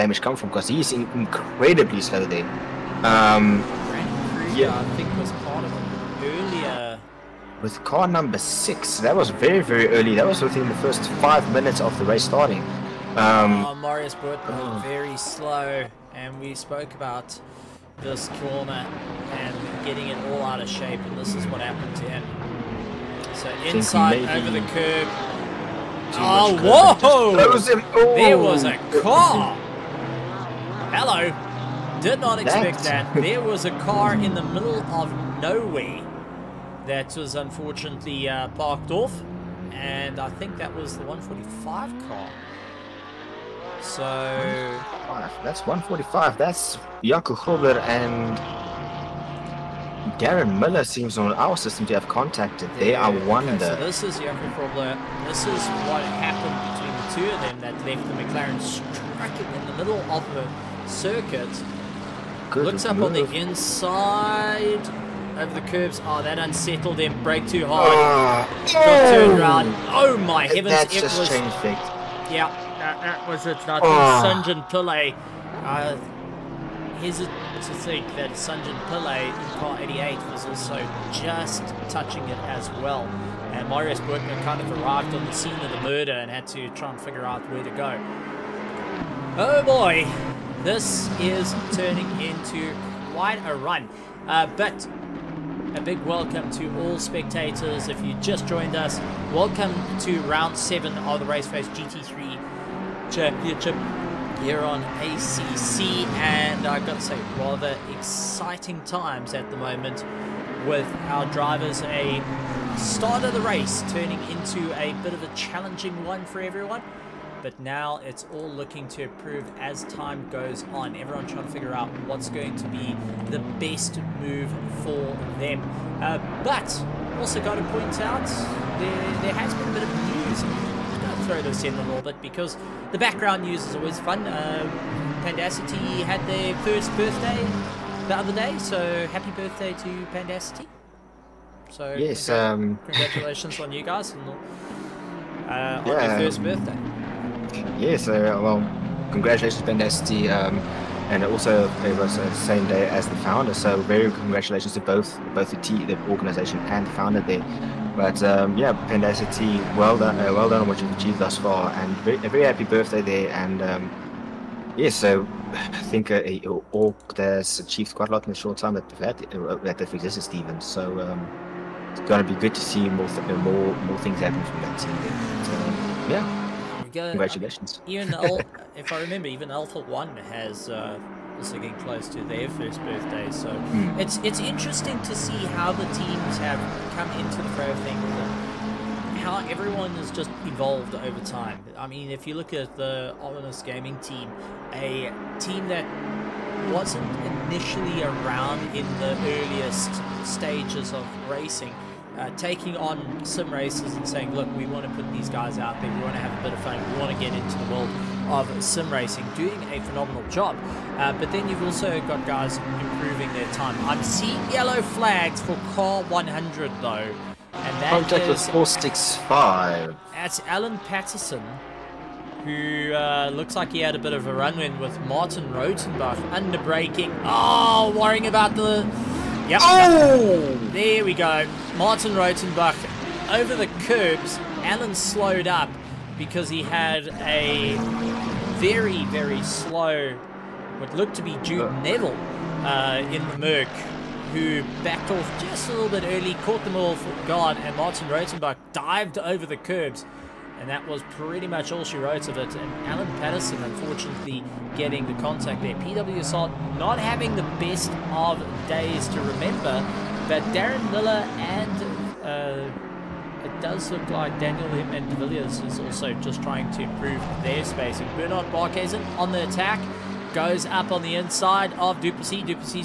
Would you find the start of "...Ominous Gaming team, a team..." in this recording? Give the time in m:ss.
3:13.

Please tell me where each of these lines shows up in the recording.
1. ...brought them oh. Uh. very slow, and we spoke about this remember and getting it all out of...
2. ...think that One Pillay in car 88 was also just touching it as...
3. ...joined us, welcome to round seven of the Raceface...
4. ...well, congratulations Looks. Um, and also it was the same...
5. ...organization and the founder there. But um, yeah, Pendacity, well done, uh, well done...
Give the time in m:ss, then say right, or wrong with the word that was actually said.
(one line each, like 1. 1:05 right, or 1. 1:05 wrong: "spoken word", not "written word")
1. 0:14 wrong: "corner", not "remember"
2. 1:17 wrong: "Sanjan", not "One"
3. 1:38 right
4. 2:28 wrong: "Pandacity", not "Looks"
5. 2:36 right.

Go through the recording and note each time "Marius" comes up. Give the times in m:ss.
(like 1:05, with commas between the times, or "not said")
0:13, 1:23.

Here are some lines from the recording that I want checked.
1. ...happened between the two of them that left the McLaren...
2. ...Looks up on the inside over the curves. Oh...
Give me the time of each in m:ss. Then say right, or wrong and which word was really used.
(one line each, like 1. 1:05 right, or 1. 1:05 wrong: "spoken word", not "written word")
1. 0:56 right
2. 1:02 right.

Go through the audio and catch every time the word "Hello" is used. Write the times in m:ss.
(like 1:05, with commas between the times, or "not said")
0:30.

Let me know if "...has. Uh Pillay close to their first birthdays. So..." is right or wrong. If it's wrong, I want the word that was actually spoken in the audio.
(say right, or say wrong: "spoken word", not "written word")
wrong: "Getting", not "Pillay".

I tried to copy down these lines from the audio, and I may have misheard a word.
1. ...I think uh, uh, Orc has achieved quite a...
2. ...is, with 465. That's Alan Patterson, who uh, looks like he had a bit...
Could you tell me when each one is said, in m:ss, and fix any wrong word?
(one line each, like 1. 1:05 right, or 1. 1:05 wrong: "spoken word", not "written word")
1. 2:45 right
2. 3:38 right.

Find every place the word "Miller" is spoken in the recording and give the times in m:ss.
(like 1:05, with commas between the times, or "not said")
0:50, 4:20.